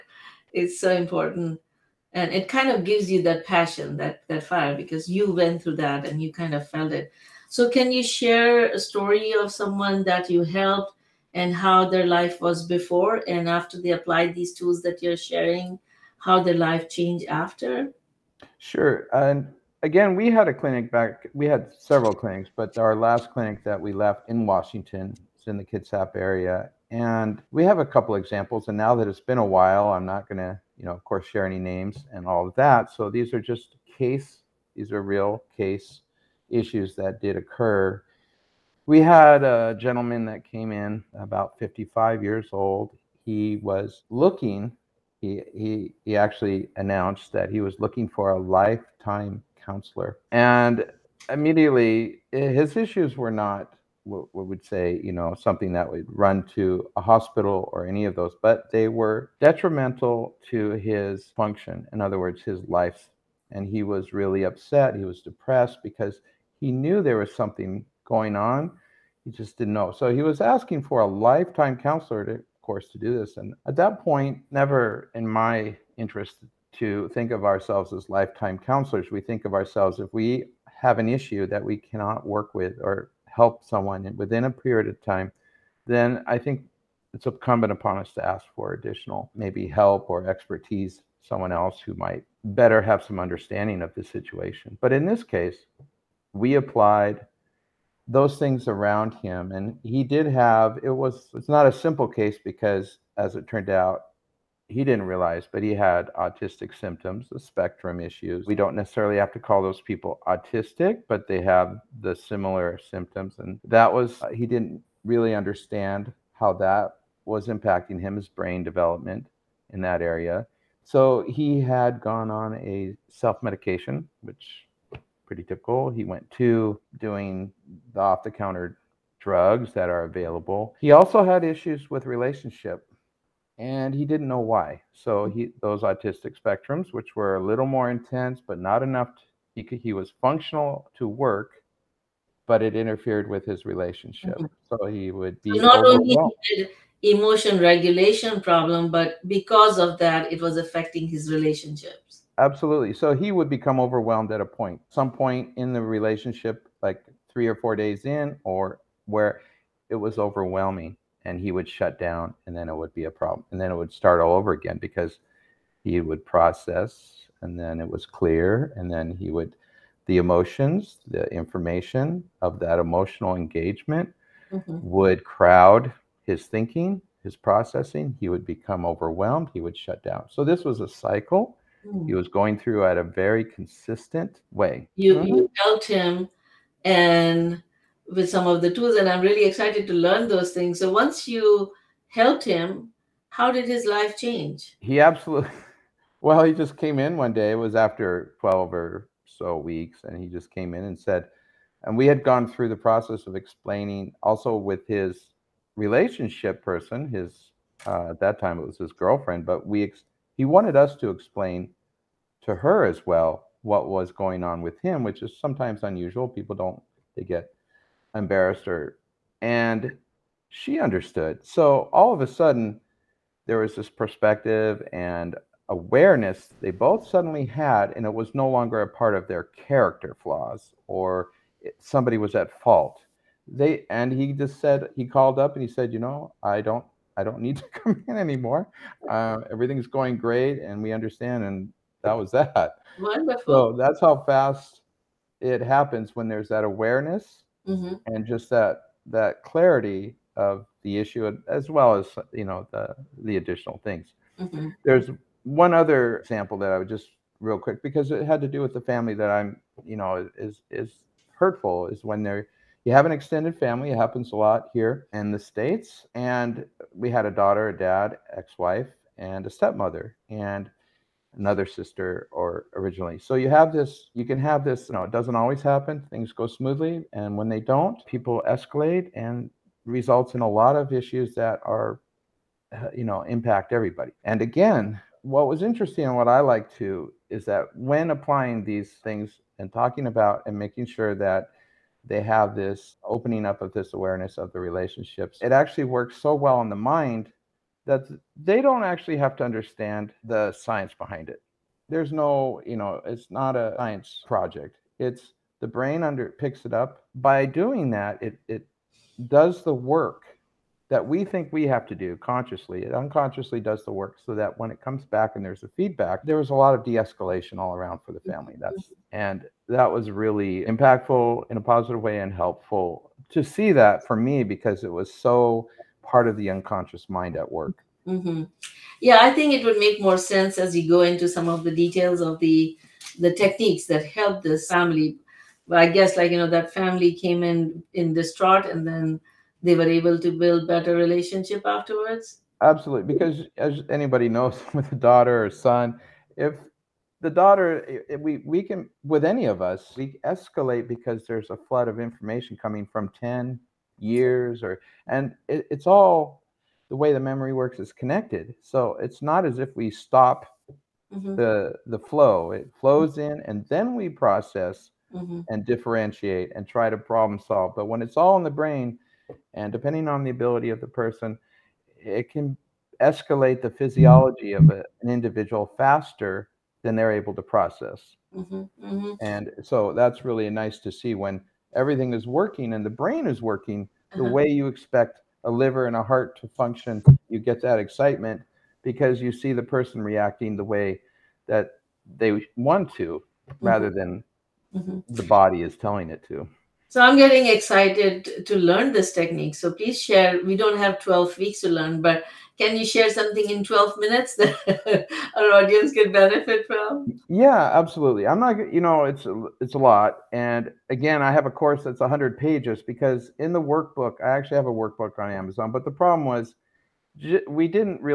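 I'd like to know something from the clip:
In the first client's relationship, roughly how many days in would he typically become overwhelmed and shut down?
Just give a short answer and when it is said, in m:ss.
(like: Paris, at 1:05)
3 or 4 days, at 2:37.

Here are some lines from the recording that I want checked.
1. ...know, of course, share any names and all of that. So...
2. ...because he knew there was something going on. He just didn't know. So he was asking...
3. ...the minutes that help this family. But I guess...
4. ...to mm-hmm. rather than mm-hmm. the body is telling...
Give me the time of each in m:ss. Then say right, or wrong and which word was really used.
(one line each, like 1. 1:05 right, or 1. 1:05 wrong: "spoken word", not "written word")
1. 0:30 right
2. 1:05 right
3. 5:33 wrong: "techniques", not "minutes"
4. 6:32 right.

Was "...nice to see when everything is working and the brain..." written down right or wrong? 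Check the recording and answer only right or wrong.
right.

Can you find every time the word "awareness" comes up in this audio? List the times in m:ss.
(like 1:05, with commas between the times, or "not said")
3:45, 4:06, 4:53.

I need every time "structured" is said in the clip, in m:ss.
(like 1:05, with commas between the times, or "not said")
not said.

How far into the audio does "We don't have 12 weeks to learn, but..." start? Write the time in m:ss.
6:40.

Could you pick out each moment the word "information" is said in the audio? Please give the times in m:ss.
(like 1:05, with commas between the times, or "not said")
2:51, 5:51.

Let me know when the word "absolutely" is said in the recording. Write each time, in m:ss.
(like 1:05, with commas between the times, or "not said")
2:32, 3:14, 5:42, 6:47.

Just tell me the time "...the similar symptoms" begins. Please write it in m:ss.
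1:52.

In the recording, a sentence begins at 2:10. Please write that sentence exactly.
He also had issues with relationship and he didn't know why.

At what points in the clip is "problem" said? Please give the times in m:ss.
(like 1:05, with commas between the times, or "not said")
2:28, 2:43, 6:06, 6:55.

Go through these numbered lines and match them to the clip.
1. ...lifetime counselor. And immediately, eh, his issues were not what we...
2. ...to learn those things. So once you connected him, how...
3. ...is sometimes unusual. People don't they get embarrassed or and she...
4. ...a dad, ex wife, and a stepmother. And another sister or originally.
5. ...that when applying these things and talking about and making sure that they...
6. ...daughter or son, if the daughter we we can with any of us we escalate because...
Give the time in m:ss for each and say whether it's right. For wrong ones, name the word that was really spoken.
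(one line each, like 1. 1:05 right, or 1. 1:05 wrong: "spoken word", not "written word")
1. 0:48 right
2. 3:09 wrong: "helped", not "connected"
3. 3:35 right
4. 4:27 right
5. 4:47 right
6. 5:44 right.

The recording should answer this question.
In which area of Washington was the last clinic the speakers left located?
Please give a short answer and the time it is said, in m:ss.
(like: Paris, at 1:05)
Kitsap, at 0:25.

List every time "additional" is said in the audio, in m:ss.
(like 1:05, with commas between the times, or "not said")
1:28, 4:13.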